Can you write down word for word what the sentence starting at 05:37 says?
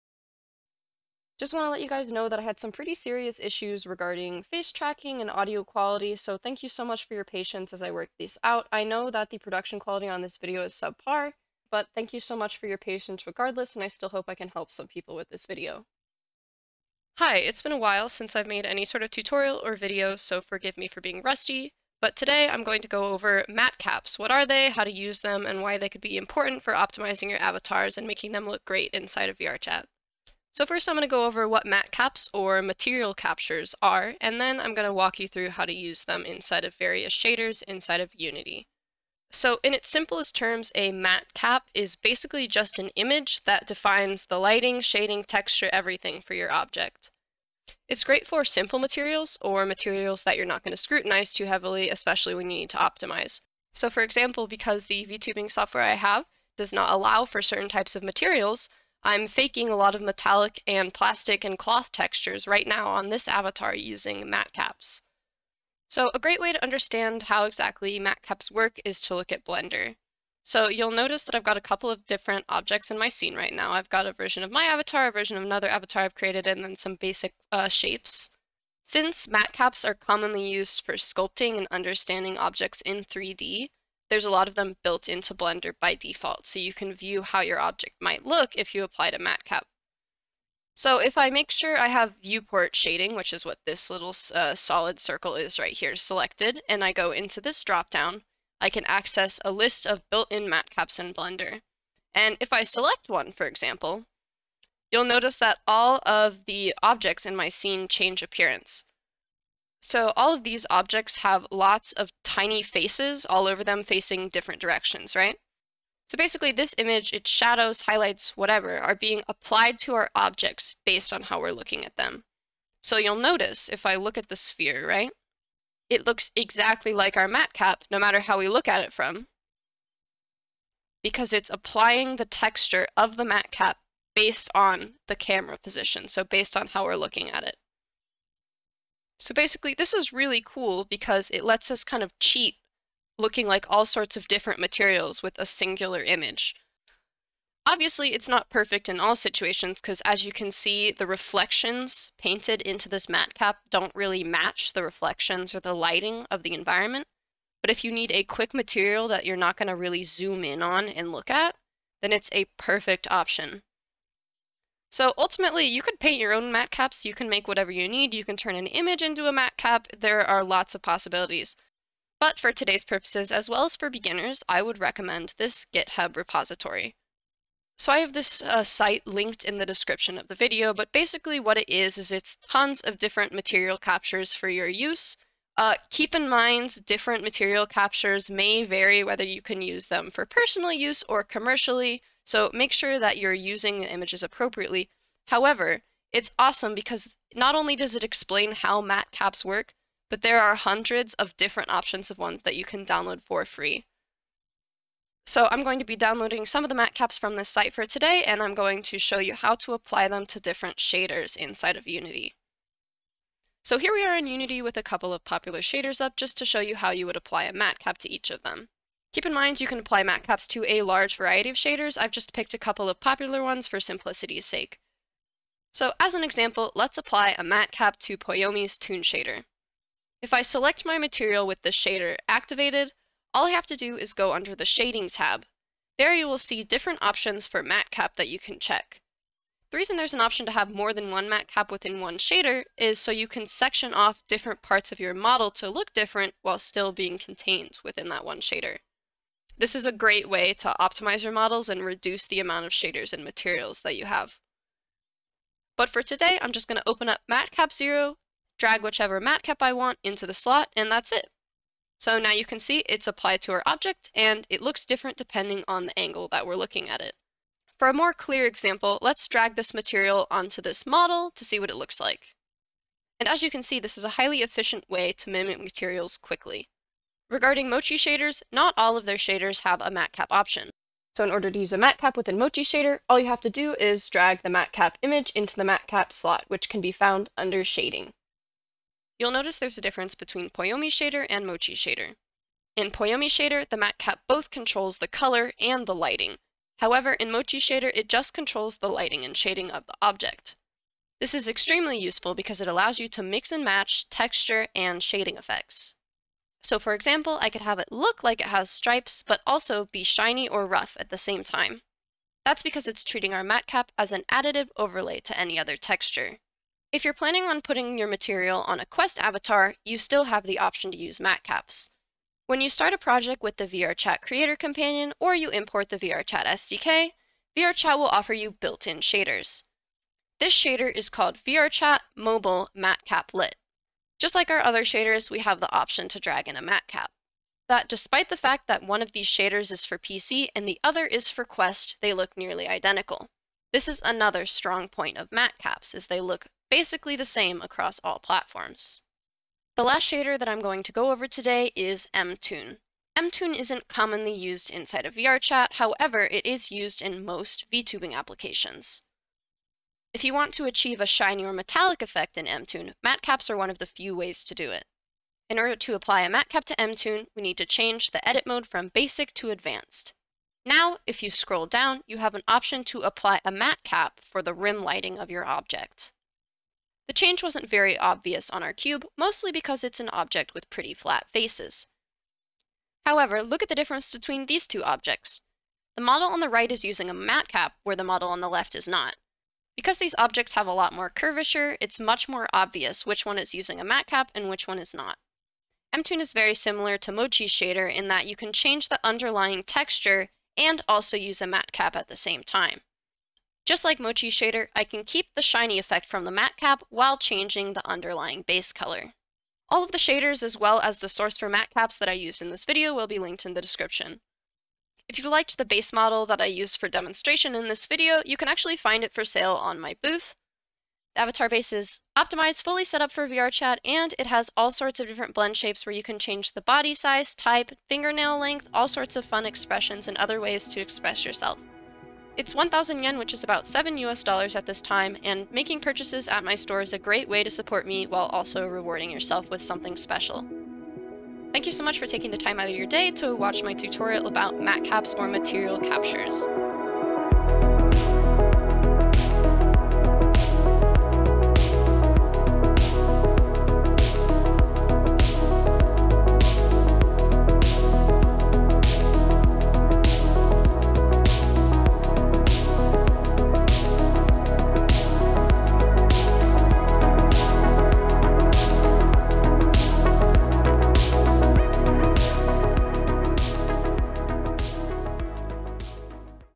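That despite the fact that one of these shaders is for PC and the other is for Quest, they look nearly identical.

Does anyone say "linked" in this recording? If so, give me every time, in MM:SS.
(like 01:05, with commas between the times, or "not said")
02:59, 06:53.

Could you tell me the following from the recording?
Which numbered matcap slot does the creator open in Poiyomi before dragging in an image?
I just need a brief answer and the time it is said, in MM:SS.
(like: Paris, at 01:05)
matcap 0, at 04:17.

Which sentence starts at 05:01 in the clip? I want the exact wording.
This is extremely useful because it allows you to mix and match texture and shading effects.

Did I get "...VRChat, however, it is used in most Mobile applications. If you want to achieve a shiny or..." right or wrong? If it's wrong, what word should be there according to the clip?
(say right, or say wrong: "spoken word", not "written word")
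wrong: "VTubing", not "Mobile".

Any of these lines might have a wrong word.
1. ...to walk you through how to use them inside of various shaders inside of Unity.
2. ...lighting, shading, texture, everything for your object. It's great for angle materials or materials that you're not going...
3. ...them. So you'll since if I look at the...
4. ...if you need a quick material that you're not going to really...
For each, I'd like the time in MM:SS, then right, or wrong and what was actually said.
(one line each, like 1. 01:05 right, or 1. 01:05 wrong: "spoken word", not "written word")
1. 00:34 right
2. 00:44 wrong: "simple", not "angle"
3. 02:01 wrong: "notice", not "since"
4. 02:37 right.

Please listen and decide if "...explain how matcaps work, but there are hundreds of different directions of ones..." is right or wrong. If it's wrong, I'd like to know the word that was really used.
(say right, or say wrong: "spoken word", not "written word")
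wrong: "options", not "directions".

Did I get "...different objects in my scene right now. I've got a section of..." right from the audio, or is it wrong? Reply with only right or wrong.
wrong.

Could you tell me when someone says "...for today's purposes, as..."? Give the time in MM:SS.
02:52.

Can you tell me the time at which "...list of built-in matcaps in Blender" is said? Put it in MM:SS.
01:39.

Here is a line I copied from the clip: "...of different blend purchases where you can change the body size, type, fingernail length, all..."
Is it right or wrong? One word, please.
wrong.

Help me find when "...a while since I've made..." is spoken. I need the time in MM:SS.
00:17.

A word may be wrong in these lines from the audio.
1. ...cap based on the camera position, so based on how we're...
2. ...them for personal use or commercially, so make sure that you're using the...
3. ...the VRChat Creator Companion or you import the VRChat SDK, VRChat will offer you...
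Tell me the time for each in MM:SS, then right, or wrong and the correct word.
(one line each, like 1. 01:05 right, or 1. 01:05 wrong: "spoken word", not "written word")
1. 02:13 right
2. 03:09 right
3. 05:23 right.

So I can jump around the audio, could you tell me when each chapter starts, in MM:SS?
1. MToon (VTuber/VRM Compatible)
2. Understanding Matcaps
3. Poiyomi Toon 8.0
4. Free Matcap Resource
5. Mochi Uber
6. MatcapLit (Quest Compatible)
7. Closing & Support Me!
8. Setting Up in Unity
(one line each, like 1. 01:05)
1. 05:49
2. 00:30
3. 03:45
4. 02:44
5. 04:40
6. 05:16
7. 06:49
8. 03:32.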